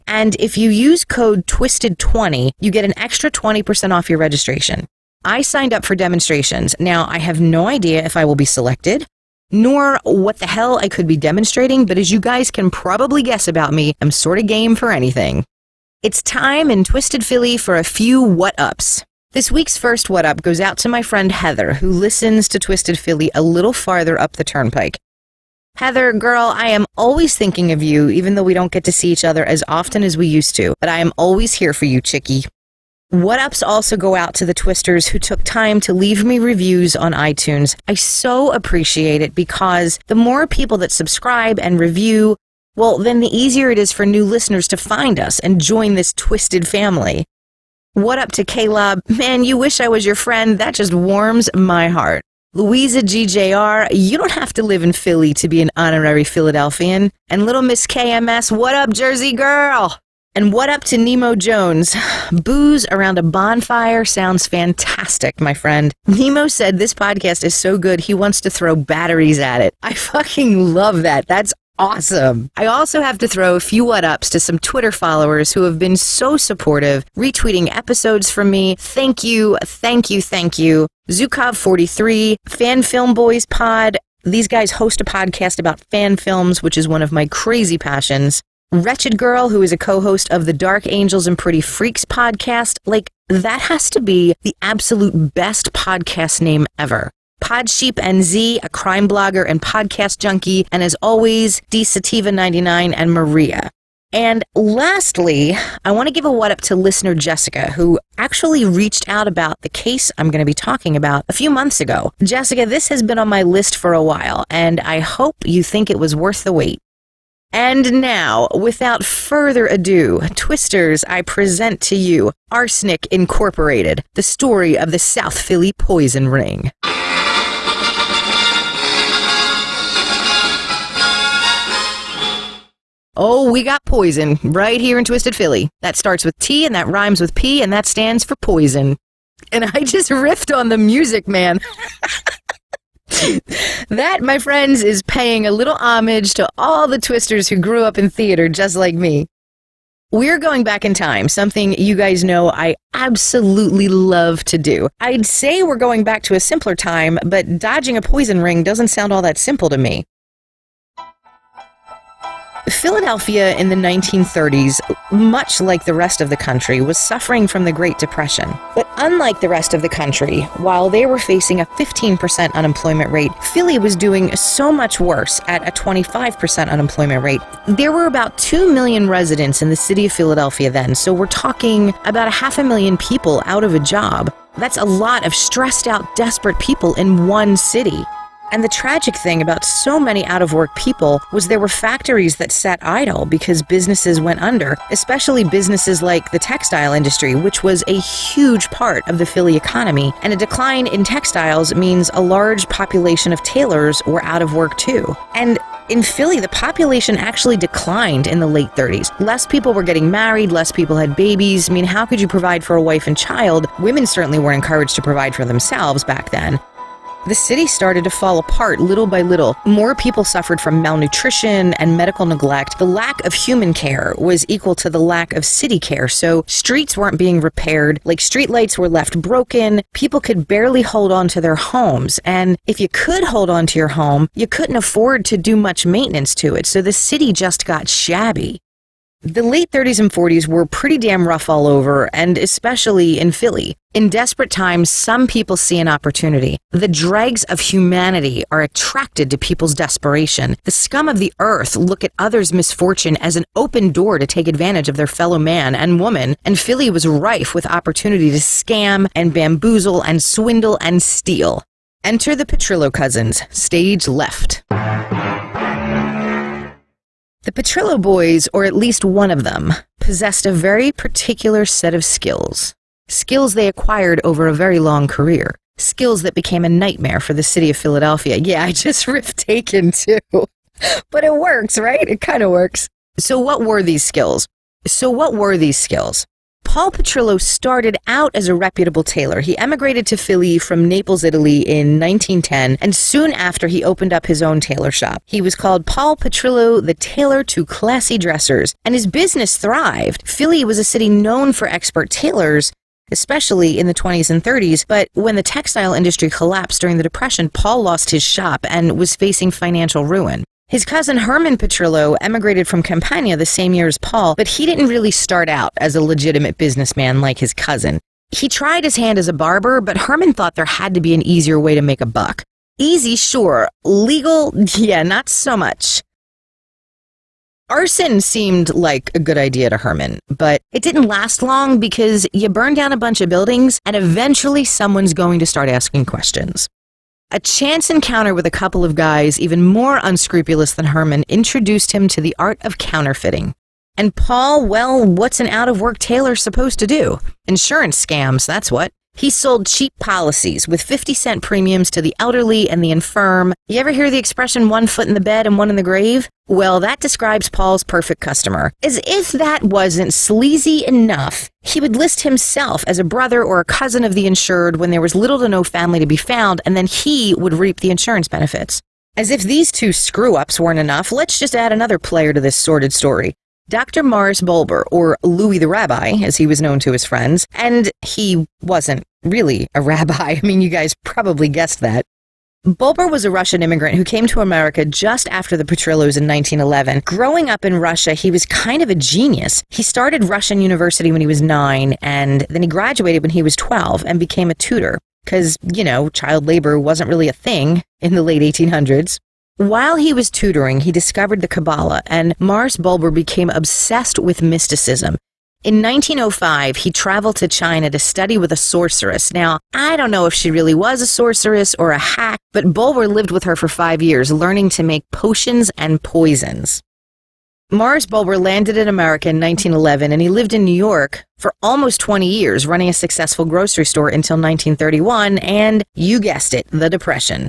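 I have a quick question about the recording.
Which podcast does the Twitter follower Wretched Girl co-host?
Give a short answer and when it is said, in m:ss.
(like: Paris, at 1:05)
Dark Angels and Pretty Freaks, at 1:30.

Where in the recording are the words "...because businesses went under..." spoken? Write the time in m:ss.
3:13.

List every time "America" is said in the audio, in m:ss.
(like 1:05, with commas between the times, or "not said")
6:24, 6:58.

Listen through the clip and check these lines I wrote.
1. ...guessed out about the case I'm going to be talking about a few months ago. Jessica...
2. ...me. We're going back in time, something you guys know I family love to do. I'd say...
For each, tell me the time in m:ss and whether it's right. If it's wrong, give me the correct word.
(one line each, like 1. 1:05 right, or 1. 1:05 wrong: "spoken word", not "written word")
1. 1:48 wrong: "reached", not "guessed"
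2. 2:28 wrong: "absolutely", not "family".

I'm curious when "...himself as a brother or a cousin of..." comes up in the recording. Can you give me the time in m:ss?
6:02.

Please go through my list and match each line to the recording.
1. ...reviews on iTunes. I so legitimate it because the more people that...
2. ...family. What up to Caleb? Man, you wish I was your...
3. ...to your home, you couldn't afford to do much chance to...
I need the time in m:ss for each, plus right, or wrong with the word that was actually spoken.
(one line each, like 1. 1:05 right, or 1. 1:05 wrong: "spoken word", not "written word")
1. 0:36 wrong: "appreciate", not "legitimate"
2. 0:46 right
3. 3:53 wrong: "maintenance", not "chance".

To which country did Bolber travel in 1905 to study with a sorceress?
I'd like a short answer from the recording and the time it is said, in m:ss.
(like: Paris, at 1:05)
China, at 6:47.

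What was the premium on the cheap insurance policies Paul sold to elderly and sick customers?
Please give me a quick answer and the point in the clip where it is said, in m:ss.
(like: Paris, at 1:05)
50 cents, at 5:50.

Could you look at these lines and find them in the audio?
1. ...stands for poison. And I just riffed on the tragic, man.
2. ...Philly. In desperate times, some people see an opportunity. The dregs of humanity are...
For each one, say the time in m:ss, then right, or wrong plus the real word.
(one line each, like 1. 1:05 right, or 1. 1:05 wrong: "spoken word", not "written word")
1. 2:17 wrong: "music", not "tragic"
2. 4:03 right.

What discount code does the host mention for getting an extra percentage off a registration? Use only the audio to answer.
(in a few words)
TWISTED20.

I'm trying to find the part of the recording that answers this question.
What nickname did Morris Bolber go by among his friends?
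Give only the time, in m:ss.
6:15.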